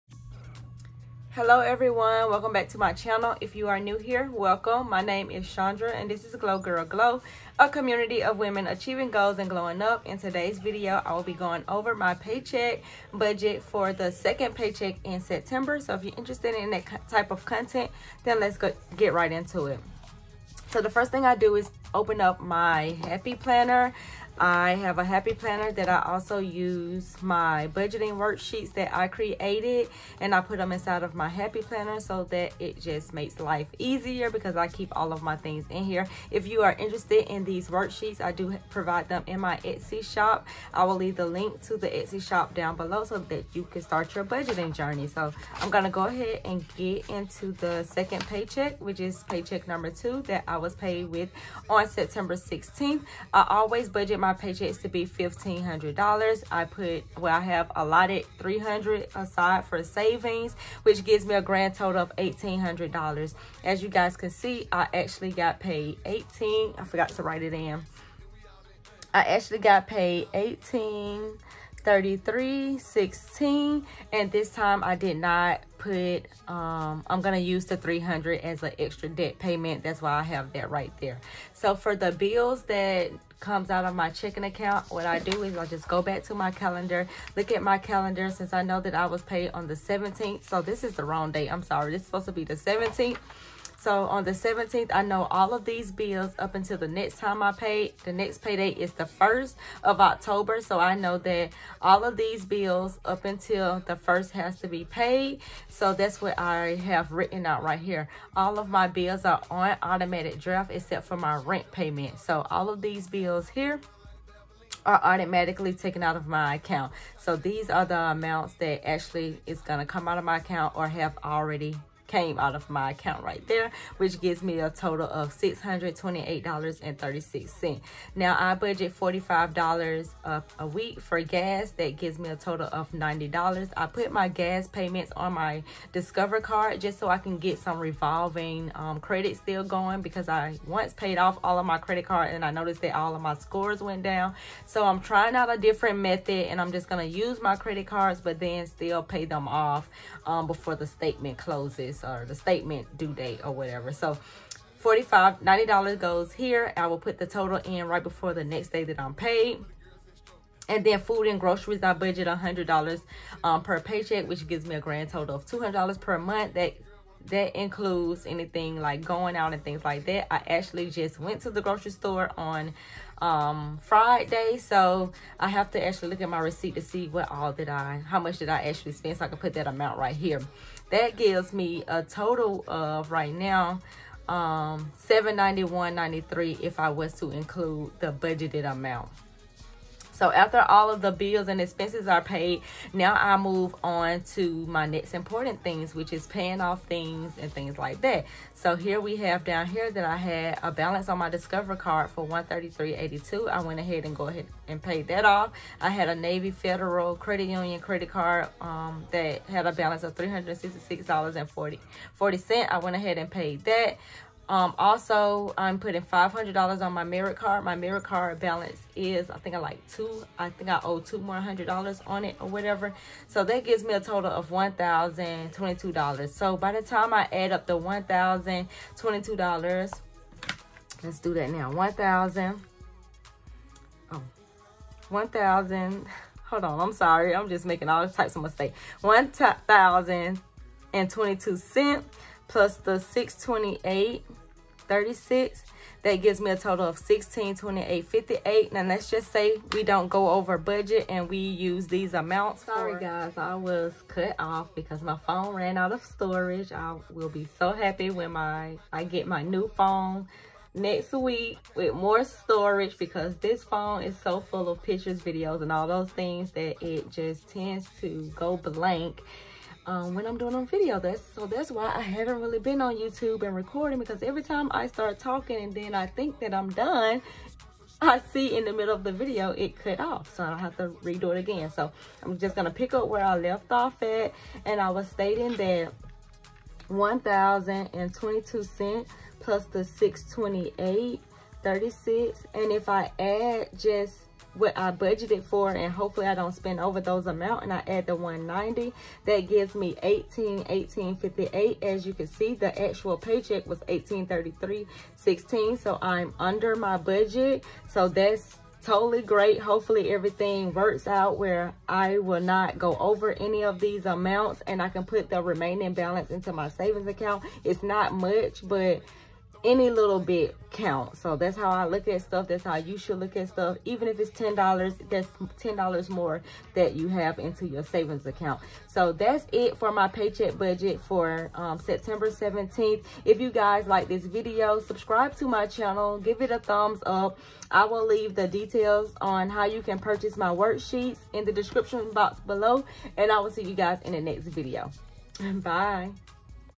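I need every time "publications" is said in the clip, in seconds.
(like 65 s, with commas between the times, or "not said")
not said.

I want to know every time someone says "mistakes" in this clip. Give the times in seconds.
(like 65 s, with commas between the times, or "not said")
238 s.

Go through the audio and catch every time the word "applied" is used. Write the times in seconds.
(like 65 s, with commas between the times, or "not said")
not said.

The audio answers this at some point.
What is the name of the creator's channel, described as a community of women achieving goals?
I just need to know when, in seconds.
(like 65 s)
6 s.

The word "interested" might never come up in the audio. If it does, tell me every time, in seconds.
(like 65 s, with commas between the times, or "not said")
16 s, 36 s.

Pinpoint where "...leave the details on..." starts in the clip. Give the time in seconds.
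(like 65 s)
338 s.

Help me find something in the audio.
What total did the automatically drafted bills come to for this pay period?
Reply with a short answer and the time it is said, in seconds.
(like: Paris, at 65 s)
$628.36, at 125 s.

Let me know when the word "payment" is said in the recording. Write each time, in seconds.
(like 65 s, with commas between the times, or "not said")
79 s, 111 s, 134 s.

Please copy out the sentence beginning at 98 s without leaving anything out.
The next payday is the 1st of October.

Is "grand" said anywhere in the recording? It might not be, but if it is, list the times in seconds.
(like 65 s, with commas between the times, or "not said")
61 s, 164 s.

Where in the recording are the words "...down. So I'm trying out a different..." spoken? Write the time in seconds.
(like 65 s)
144 s.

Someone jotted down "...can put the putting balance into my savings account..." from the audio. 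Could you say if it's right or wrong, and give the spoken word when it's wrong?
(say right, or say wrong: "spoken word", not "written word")
wrong: "remaining", not "putting".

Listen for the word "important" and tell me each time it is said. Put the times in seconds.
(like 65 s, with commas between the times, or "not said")
195 s.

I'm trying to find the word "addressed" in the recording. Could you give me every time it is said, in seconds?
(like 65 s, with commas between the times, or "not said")
not said.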